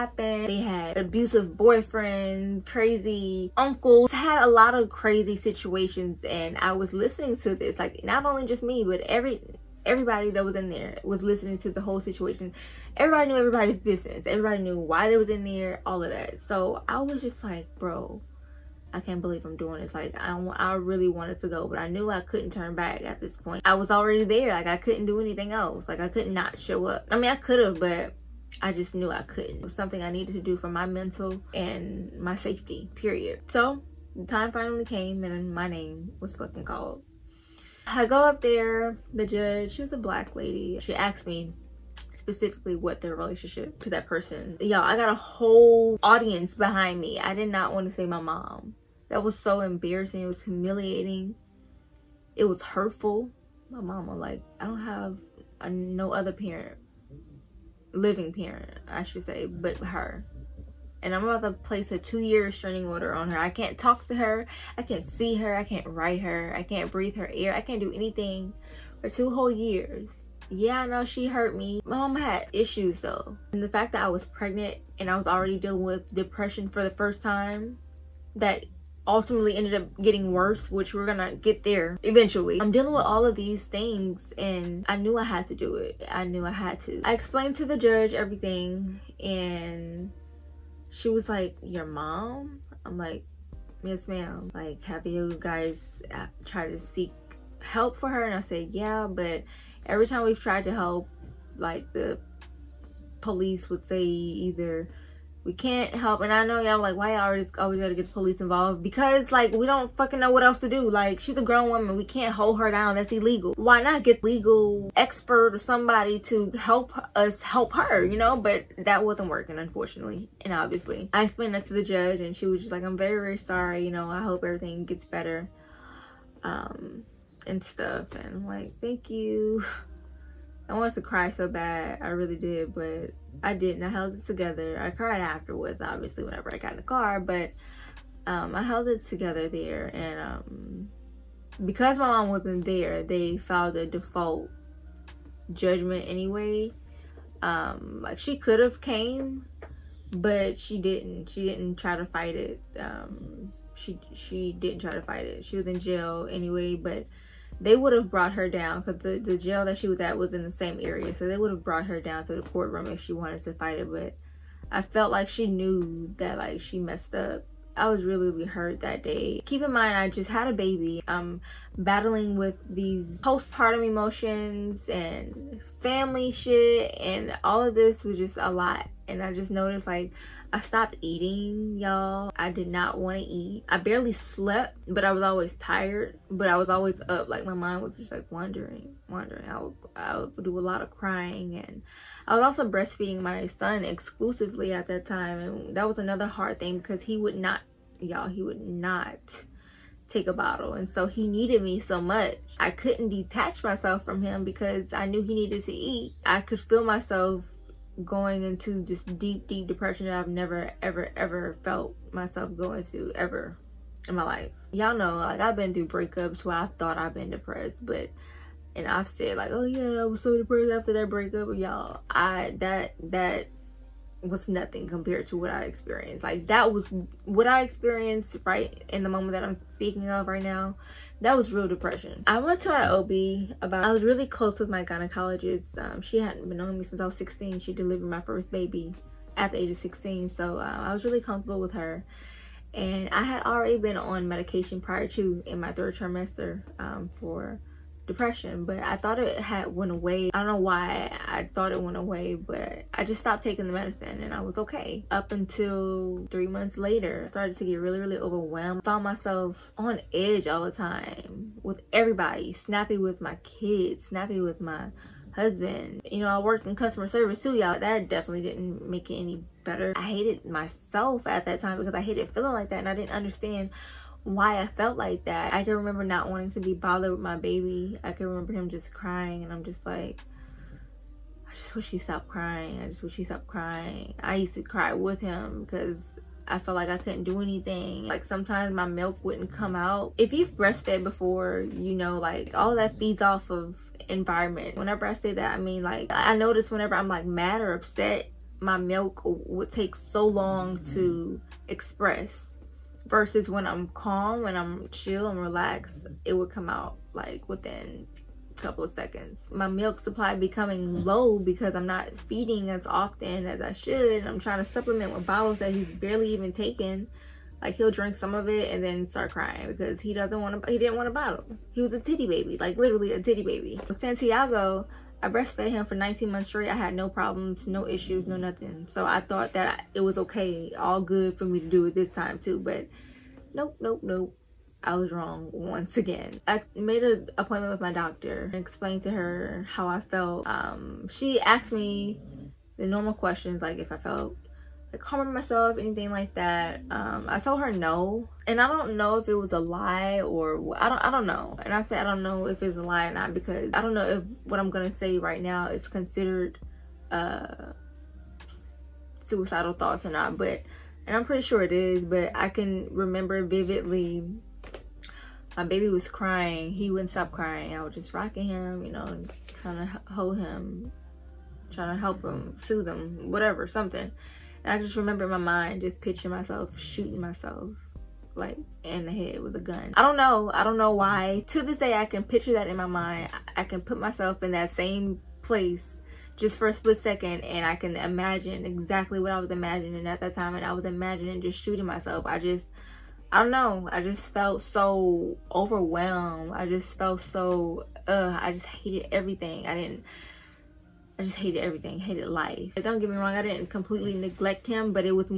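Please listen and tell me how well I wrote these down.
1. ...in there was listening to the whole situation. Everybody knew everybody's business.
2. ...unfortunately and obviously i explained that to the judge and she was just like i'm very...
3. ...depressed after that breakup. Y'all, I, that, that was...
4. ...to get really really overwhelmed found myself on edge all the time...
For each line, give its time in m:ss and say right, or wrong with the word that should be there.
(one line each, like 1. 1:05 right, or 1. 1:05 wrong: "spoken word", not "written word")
1. 0:10 right
2. 1:59 right
3. 3:40 right
4. 4:17 right.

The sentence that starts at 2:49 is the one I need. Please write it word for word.
Keep in mind, I just had a baby.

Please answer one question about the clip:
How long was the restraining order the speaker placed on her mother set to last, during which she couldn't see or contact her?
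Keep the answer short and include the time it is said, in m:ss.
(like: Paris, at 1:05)
2 years, at 1:01.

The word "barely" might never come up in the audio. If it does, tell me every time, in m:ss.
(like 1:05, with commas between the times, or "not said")
3:03, 5:15.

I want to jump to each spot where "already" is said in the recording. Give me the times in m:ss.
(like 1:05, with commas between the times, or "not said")
0:23, 1:15, 4:03.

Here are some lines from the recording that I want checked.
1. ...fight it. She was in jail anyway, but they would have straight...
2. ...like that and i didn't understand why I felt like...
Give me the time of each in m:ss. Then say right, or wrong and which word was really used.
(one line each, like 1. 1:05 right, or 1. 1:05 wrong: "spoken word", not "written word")
1. 2:35 wrong: "brought", not "straight"
2. 4:32 right.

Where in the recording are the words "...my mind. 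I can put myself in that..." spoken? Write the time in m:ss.
6:22.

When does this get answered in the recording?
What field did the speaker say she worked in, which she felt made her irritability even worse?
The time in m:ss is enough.
4:26.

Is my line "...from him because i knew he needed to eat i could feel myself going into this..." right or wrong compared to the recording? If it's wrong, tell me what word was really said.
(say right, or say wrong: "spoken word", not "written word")
right.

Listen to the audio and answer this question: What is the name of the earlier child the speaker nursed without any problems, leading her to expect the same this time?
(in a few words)
Santiago.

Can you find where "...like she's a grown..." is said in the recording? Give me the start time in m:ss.
1:50.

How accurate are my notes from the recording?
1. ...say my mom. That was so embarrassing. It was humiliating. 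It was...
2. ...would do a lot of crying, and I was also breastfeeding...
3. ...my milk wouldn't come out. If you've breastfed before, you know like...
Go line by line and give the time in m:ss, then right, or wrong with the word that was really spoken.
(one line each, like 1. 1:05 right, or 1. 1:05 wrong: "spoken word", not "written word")
1. 0:47 right
2. 3:10 right
3. 4:48 right.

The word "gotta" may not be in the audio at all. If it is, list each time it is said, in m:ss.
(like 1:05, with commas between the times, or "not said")
1:47.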